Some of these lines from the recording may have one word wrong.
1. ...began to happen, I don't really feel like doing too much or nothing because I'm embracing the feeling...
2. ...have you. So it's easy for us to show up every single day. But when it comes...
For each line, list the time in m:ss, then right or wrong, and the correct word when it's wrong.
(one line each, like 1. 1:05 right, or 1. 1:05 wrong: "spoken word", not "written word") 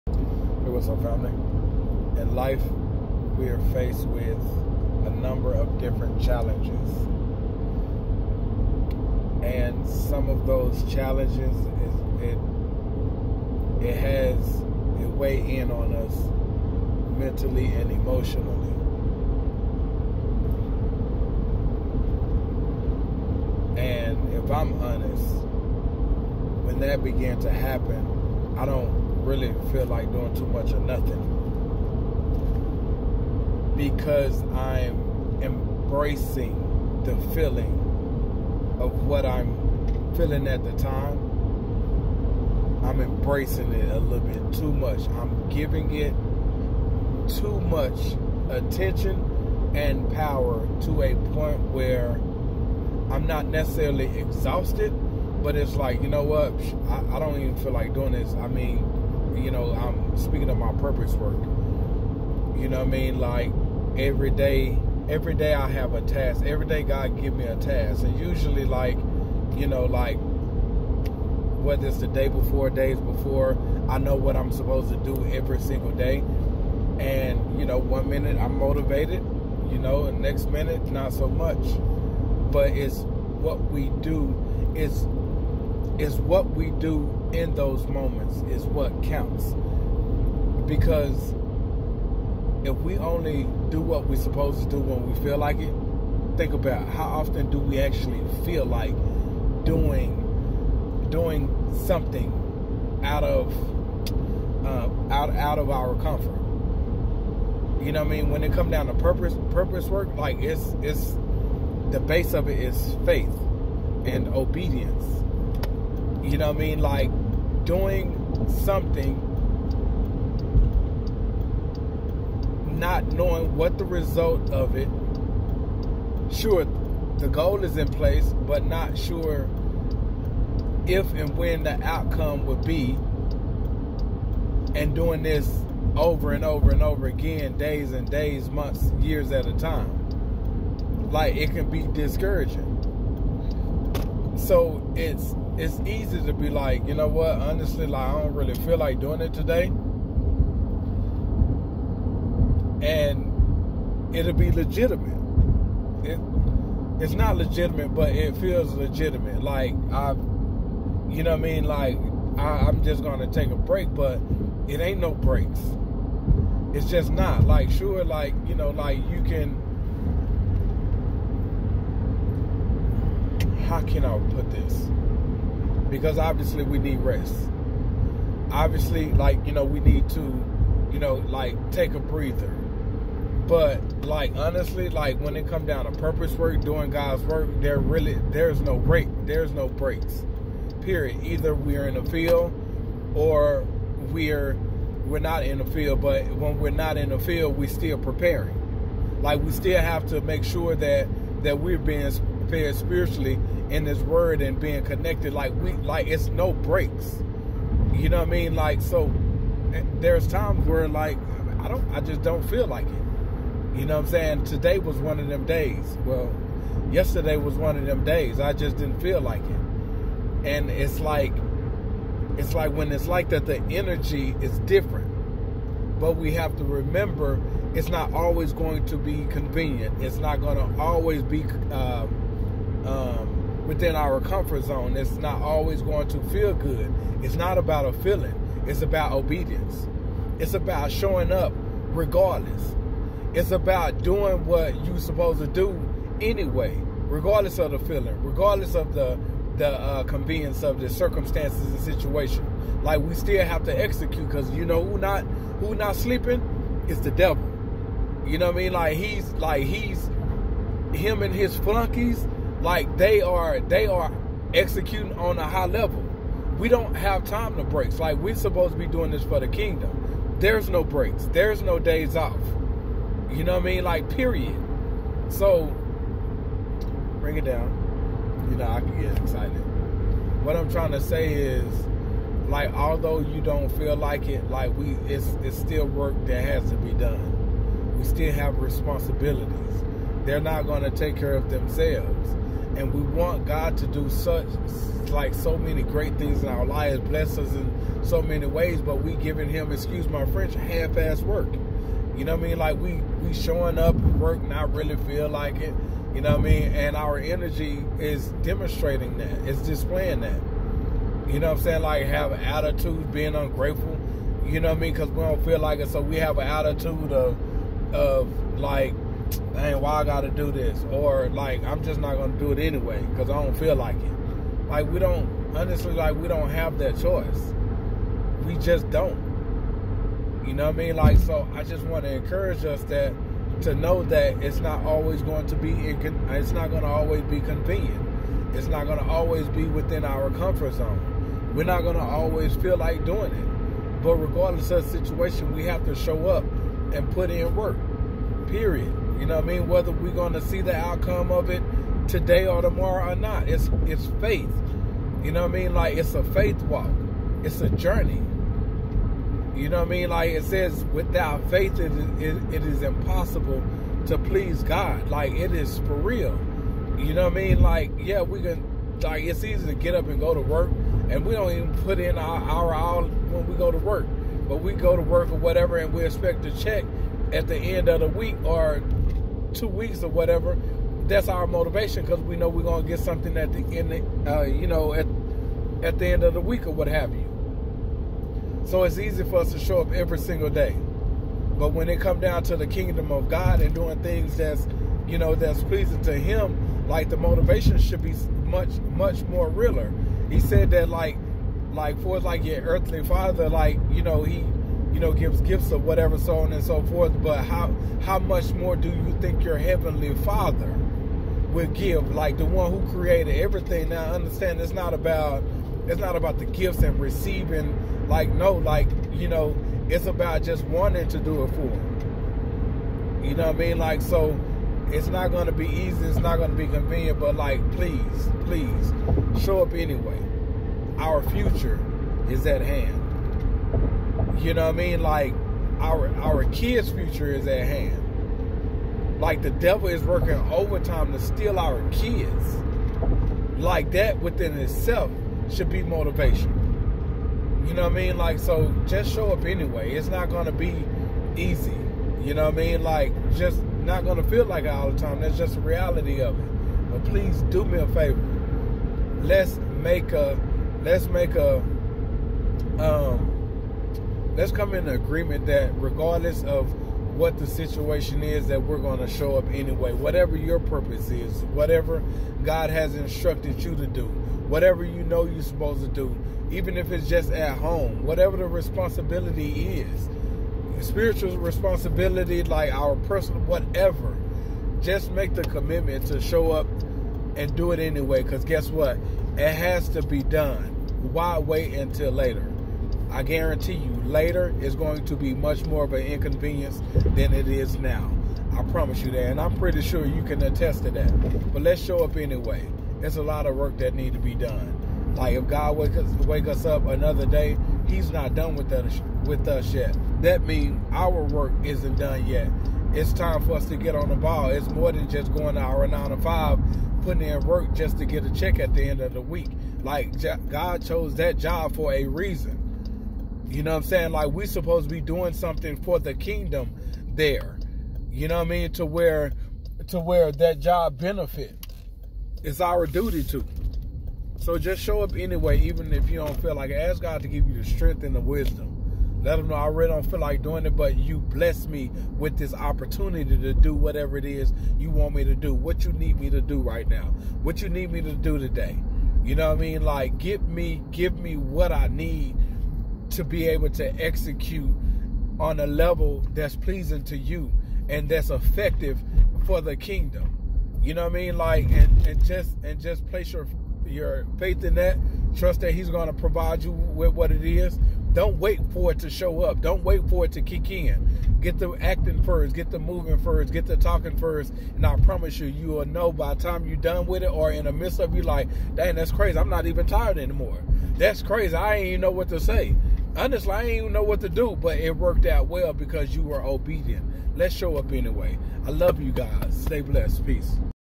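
1. 0:27 right
2. 6:26 right.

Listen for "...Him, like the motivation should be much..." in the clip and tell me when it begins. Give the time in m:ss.
6:36.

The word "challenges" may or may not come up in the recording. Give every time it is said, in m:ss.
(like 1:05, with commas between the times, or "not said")
0:06, 0:10.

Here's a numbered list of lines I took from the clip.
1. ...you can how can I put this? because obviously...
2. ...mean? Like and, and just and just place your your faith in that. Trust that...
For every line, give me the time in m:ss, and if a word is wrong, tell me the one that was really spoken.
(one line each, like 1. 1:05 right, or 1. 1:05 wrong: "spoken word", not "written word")
1. 2:49 right
2. 9:21 right.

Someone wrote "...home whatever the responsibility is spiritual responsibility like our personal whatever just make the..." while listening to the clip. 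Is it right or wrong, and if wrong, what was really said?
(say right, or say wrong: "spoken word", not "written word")
right.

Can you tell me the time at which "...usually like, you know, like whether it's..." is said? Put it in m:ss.
1:08.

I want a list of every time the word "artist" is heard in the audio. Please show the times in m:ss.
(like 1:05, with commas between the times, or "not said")
not said.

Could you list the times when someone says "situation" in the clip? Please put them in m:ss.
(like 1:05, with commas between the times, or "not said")
4:11, 5:44, 7:47.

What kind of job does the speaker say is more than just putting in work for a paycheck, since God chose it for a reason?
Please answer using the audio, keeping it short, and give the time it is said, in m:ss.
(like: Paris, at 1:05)
nine to five, at 8:35.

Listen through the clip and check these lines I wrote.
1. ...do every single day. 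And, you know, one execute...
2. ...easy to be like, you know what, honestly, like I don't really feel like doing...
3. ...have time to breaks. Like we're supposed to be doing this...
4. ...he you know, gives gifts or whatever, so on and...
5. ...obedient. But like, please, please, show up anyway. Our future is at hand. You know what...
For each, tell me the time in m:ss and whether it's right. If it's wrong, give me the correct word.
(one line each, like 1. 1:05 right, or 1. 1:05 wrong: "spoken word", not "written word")
1. 1:14 wrong: "minute", not "execute"
2. 2:25 right
3. 4:26 right
4. 6:44 right
5. 7:06 wrong: "convenient", not "obedient".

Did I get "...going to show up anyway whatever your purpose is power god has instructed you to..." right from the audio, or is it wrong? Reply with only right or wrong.
wrong.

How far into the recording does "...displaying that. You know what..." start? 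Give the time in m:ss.
5:09.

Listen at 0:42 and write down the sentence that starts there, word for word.
I'm embracing it a little bit too much.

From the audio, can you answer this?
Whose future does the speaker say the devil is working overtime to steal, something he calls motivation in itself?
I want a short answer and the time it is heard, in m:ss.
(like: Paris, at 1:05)
our kids, at 7:21.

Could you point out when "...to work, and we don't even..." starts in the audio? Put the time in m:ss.
6:10.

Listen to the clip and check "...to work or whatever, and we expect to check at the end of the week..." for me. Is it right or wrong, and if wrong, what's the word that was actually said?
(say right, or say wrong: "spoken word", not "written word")
right.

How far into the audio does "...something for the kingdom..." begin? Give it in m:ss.
8:45.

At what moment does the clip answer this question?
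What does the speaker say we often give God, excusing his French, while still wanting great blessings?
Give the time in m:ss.
5:00.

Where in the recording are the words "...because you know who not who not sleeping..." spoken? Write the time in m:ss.
4:14.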